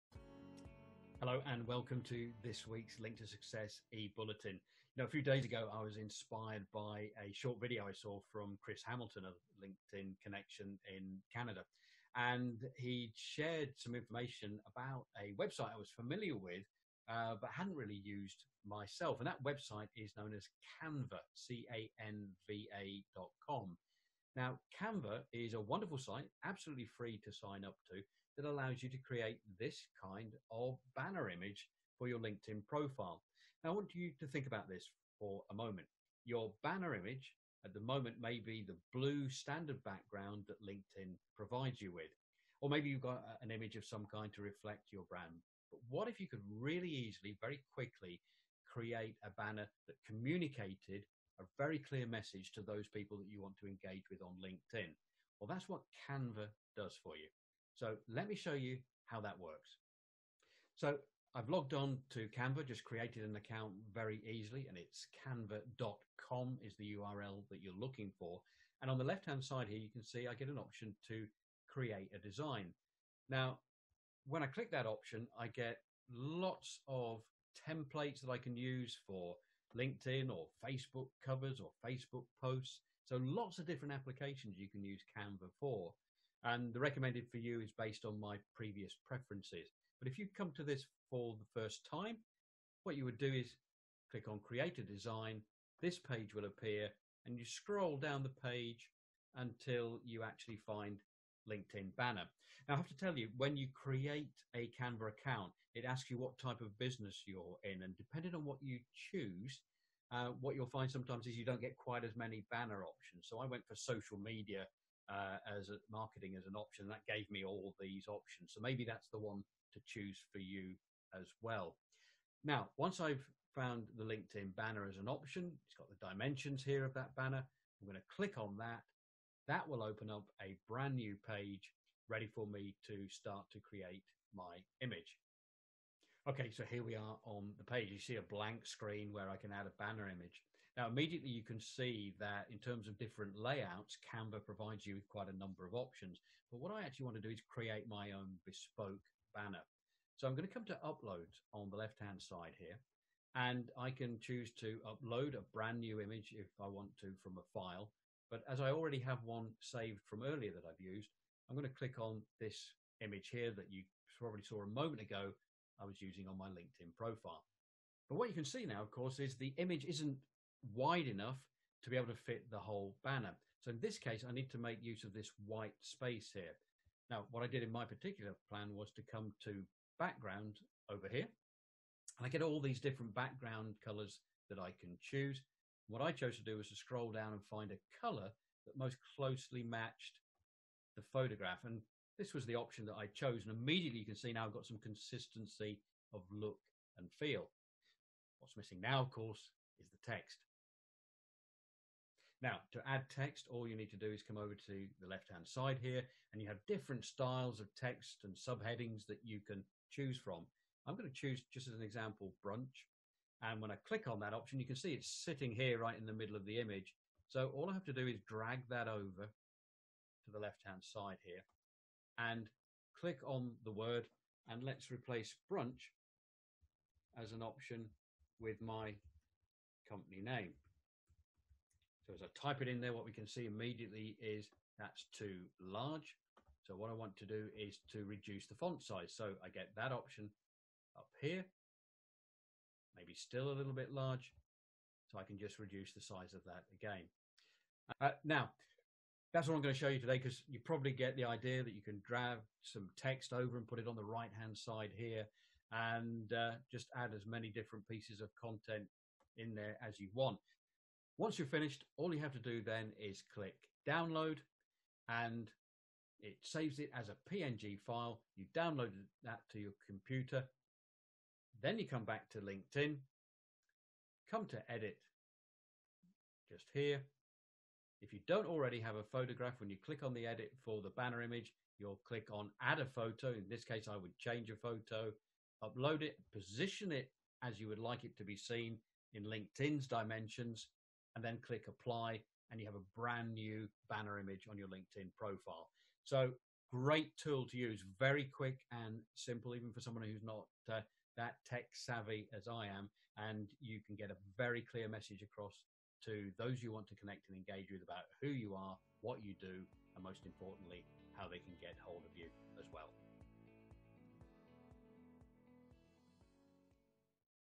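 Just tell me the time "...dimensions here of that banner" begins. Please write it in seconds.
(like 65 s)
126 s.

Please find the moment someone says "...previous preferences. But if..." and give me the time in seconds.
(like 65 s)
88 s.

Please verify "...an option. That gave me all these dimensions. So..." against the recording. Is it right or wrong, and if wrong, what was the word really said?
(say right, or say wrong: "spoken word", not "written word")
wrong: "options", not "dimensions".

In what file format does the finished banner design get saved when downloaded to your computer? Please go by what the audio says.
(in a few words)
PNG.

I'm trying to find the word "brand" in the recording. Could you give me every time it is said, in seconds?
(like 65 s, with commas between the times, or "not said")
45 s, 130 s, 155 s, 292 s.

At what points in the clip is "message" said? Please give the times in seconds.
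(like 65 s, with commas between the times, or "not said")
52 s, 304 s.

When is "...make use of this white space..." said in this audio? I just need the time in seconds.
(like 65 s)
174 s.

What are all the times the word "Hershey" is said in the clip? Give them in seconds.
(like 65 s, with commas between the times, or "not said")
not said.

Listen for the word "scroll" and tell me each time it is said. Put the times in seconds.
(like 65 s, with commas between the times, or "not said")
97 s, 186 s.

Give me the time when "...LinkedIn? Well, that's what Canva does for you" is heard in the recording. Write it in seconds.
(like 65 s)
54 s.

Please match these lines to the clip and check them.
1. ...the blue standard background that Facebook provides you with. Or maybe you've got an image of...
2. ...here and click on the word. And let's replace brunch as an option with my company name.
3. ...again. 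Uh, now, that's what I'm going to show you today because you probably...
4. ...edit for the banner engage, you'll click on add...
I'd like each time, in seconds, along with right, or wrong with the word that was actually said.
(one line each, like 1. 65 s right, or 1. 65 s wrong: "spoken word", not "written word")
1. 38 s wrong: "LinkedIn", not "Facebook"
2. 221 s right
3. 246 s right
4. 280 s wrong: "image", not "engage".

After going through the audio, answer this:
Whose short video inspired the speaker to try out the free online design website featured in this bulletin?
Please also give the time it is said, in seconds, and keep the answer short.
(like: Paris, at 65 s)
Chris Hamilton, at 8 s.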